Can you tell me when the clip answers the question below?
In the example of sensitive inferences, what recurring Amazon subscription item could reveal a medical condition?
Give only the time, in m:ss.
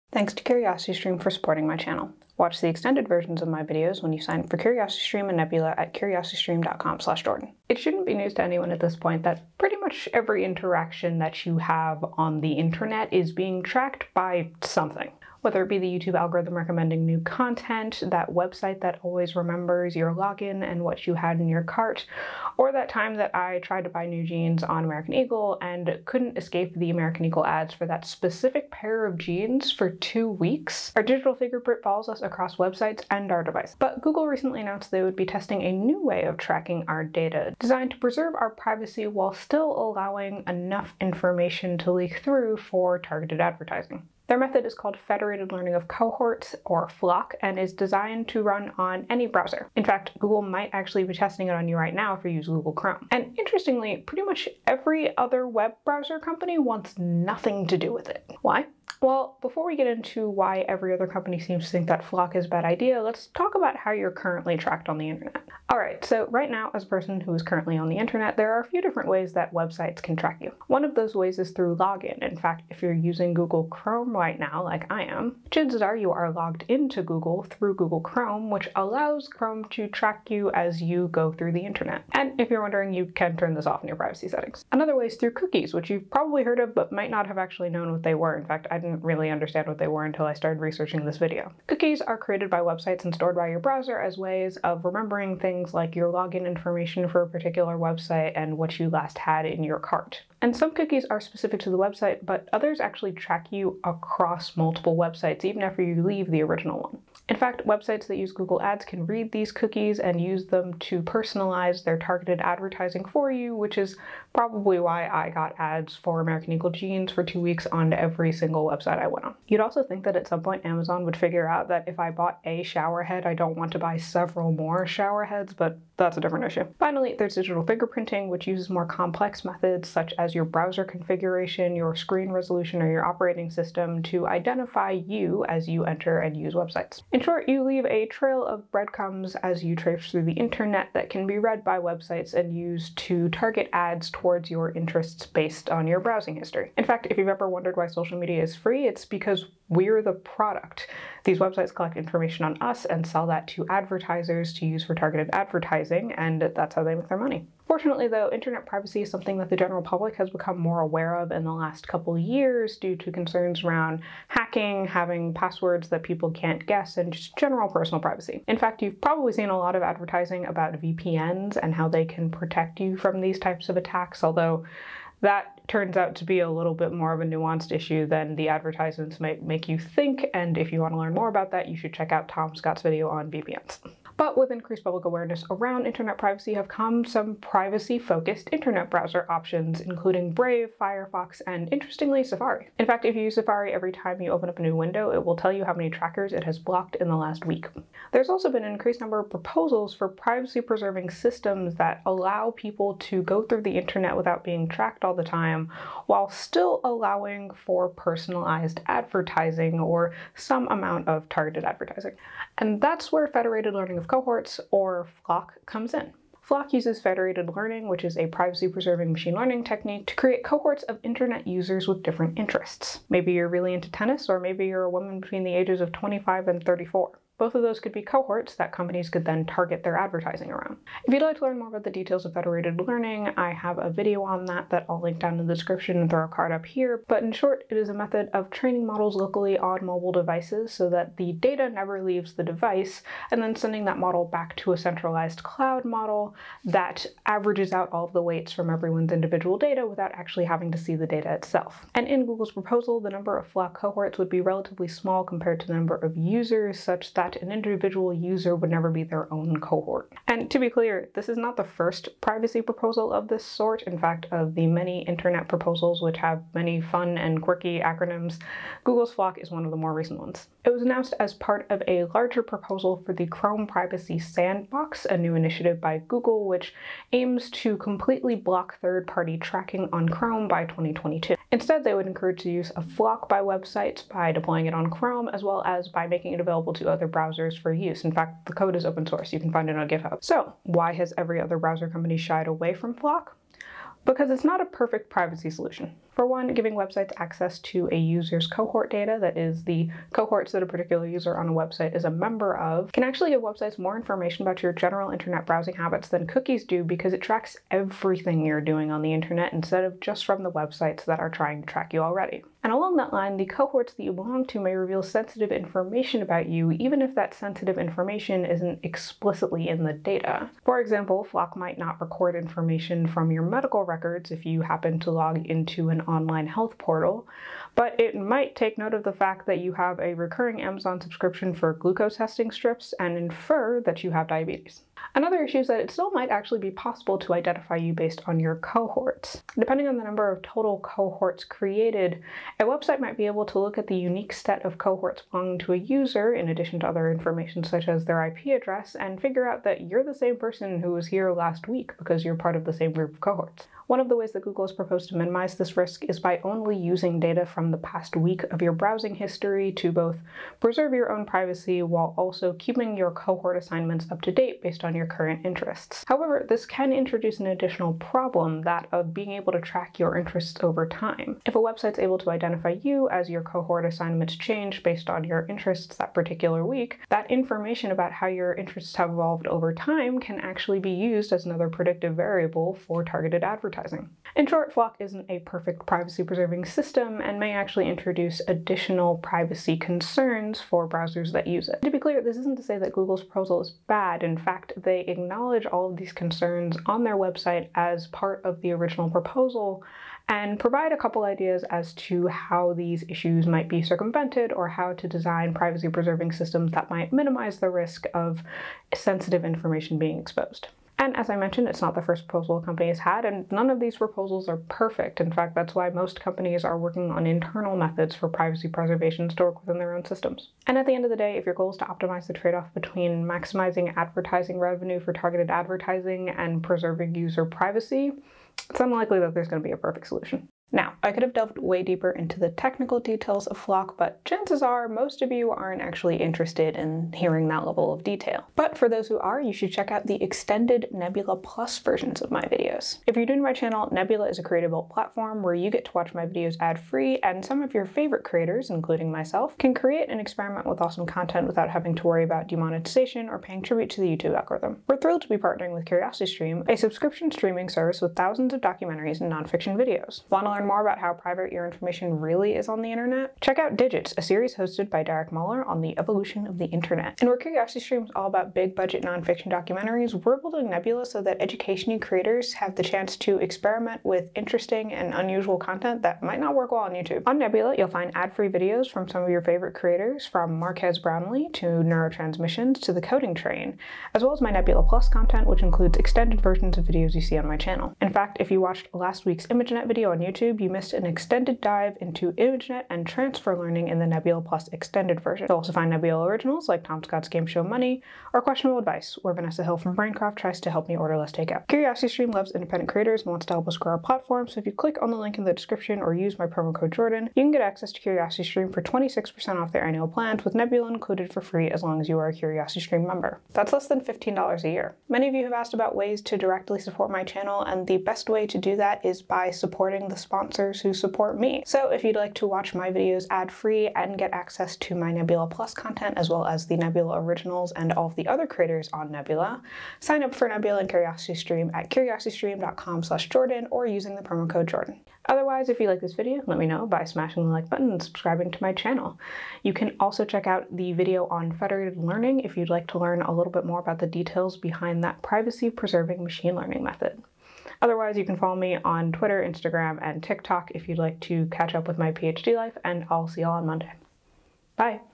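5:31.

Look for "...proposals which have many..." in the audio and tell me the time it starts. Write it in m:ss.
4:25.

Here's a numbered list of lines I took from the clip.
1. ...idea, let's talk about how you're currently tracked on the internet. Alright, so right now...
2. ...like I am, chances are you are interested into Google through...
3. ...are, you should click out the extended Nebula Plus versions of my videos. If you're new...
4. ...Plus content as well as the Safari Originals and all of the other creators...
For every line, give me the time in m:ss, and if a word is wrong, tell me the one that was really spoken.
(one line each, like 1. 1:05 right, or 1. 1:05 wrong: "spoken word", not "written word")
1. 1:02 right
2. 1:14 wrong: "logged", not "interested"
3. 7:19 wrong: "check", not "click"
4. 8:45 wrong: "Nebula", not "Safari".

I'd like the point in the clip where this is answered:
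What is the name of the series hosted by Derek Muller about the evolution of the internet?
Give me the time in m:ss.
7:43.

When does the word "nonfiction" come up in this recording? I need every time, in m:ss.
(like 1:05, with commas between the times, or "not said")
7:39, 7:49.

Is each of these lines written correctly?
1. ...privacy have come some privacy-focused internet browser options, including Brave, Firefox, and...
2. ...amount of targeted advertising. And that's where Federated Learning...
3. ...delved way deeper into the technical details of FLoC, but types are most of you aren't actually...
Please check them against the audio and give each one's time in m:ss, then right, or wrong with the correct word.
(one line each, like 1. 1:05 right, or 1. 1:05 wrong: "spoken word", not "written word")
1. 3:06 right
2. 3:30 right
3. 7:11 wrong: "chances", not "types".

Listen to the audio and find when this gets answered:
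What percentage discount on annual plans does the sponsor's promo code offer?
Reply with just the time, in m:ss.
8:28.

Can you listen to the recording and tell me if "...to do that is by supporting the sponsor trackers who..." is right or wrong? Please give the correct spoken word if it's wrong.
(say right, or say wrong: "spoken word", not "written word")
wrong: "sponsors", not "trackers".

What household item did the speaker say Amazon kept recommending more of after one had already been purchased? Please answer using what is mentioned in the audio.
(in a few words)
shower head.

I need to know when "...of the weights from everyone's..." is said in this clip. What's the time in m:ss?
4:08.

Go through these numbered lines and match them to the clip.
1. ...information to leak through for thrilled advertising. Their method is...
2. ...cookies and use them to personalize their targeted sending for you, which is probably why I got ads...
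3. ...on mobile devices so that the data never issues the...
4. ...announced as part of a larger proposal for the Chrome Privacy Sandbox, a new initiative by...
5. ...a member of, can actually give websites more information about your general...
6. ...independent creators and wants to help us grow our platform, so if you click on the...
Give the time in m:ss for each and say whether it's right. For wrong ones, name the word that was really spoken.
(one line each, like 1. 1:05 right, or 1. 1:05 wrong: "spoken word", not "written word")
1. 0:41 wrong: "targeted", not "thrilled"
2. 1:49 wrong: "advertising", not "sending"
3. 3:59 wrong: "leaves", not "issues"
4. 4:30 right
5. 5:02 right
6. 8:22 right.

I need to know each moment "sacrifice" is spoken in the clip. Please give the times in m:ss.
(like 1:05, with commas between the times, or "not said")
not said.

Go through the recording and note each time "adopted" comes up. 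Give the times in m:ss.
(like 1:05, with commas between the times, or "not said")
not said.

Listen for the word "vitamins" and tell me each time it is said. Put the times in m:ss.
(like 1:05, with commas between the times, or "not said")
not said.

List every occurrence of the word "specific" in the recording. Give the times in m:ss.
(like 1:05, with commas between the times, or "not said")
0:28, 1:41.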